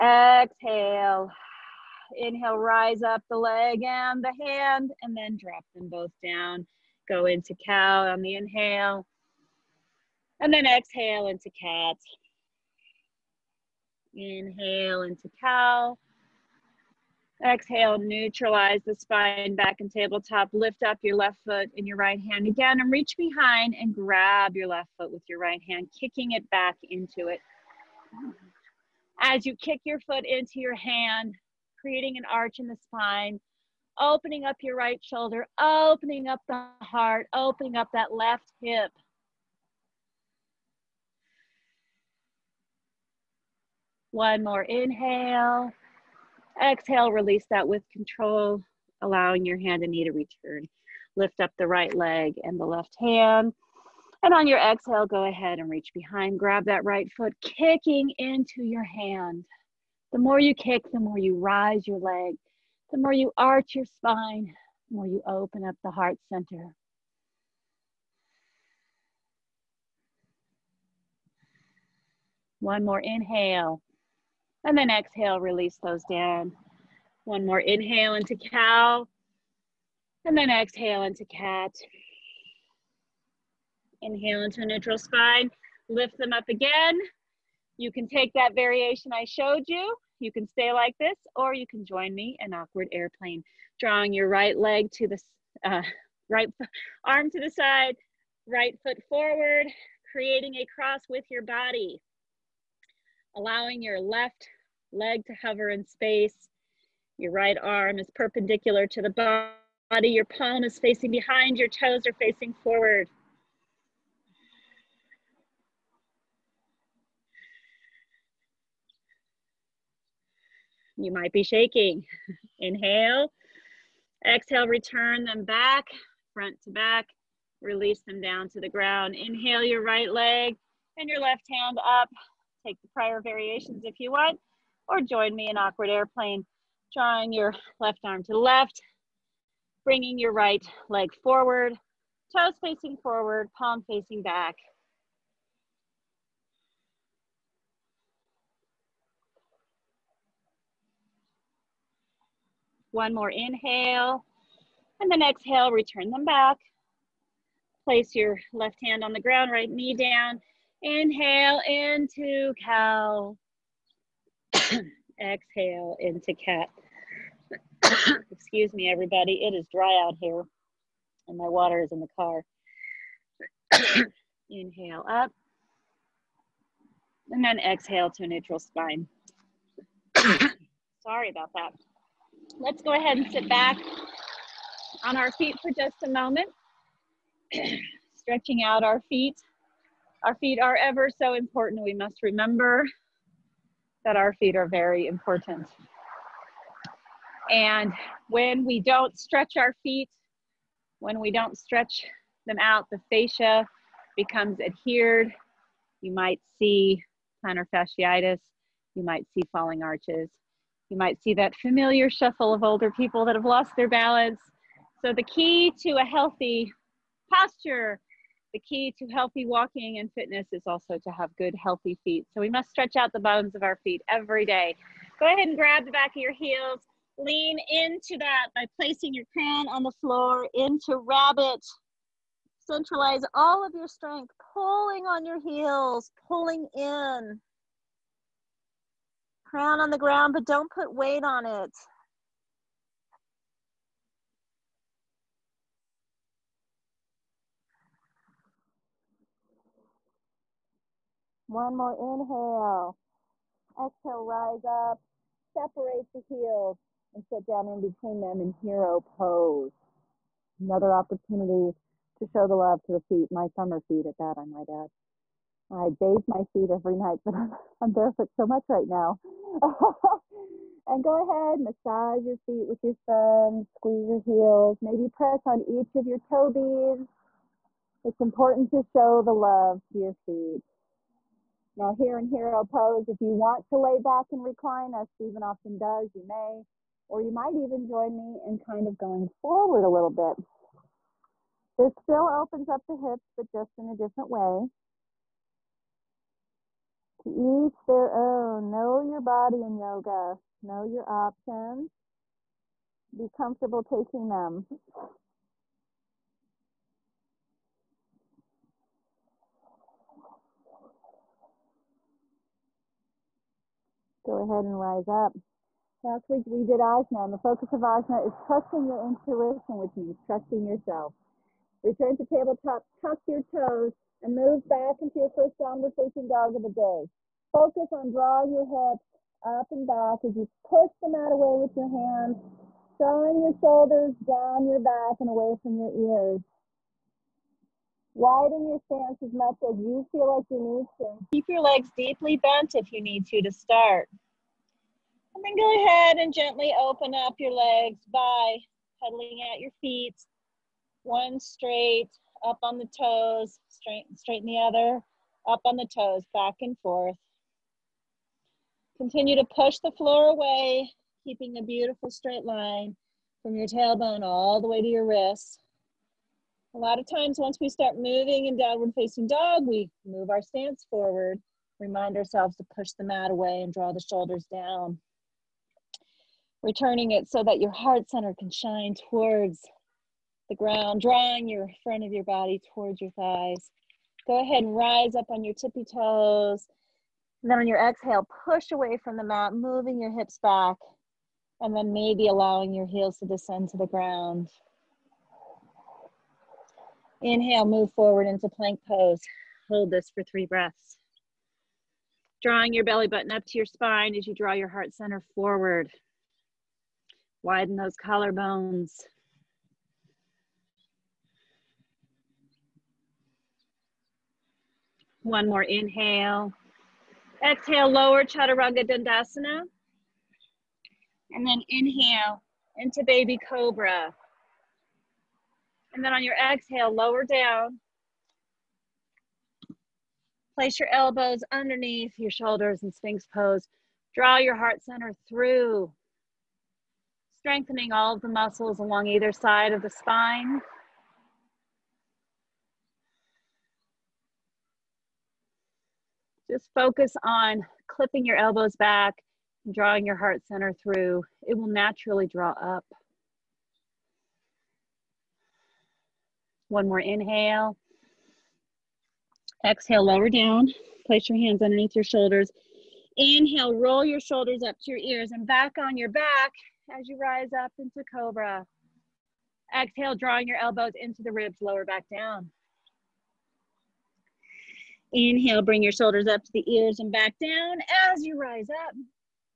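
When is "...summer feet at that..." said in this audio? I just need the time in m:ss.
4:23.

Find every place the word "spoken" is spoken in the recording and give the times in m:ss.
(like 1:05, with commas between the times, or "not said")
not said.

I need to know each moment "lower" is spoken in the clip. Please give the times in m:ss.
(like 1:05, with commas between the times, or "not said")
6:57, 7:06, 7:40, 7:51.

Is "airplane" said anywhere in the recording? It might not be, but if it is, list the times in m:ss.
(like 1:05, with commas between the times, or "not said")
1:32, 2:15.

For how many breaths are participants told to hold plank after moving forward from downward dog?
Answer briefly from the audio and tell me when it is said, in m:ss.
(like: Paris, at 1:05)
3, at 6:40.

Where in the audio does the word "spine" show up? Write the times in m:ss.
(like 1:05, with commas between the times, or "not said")
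0:18, 0:32, 1:03, 1:24, 2:58, 6:43, 7:19.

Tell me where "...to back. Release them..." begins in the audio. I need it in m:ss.
2:06.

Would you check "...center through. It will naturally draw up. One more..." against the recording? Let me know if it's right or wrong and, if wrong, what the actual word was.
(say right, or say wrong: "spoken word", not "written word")
right.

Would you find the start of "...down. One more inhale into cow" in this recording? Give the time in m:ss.
1:16.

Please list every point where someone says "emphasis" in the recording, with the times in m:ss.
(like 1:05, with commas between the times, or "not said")
not said.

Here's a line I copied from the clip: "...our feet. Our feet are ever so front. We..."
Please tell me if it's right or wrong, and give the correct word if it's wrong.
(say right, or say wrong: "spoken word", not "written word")
wrong: "important", not "front".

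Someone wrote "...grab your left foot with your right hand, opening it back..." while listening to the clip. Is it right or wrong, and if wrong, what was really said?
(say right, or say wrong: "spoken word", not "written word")
wrong: "kicking", not "opening".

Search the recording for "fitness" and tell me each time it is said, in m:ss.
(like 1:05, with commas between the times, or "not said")
3:40.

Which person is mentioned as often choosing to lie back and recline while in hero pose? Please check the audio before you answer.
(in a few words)
Stephen.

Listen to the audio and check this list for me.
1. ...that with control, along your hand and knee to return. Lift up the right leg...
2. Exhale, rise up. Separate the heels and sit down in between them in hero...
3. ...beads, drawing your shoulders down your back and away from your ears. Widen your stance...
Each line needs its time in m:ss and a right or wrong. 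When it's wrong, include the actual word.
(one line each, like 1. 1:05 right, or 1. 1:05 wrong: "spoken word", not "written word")
1. 0:47 wrong: "allowing", not "along"
2. 4:13 right
3. 5:31 wrong: "hands", not "beads".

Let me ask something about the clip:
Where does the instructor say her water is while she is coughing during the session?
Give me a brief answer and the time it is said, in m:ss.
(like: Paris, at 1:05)
In the car, at 2:51.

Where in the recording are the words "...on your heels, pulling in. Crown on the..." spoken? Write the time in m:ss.
3:55.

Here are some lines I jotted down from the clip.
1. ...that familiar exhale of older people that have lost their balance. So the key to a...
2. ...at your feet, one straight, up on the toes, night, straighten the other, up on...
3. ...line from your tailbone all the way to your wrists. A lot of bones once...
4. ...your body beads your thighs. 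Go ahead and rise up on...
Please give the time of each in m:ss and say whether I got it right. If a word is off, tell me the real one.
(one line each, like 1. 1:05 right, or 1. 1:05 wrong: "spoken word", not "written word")
1. 3:31 wrong: "shuffle", not "exhale"
2. 5:49 wrong: "straight", not "night"
3. 6:02 wrong: "times", not "bones"
4. 6:22 wrong: "towards", not "beads".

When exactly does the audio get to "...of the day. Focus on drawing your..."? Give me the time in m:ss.
5:26.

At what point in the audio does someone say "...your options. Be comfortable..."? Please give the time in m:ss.
5:00.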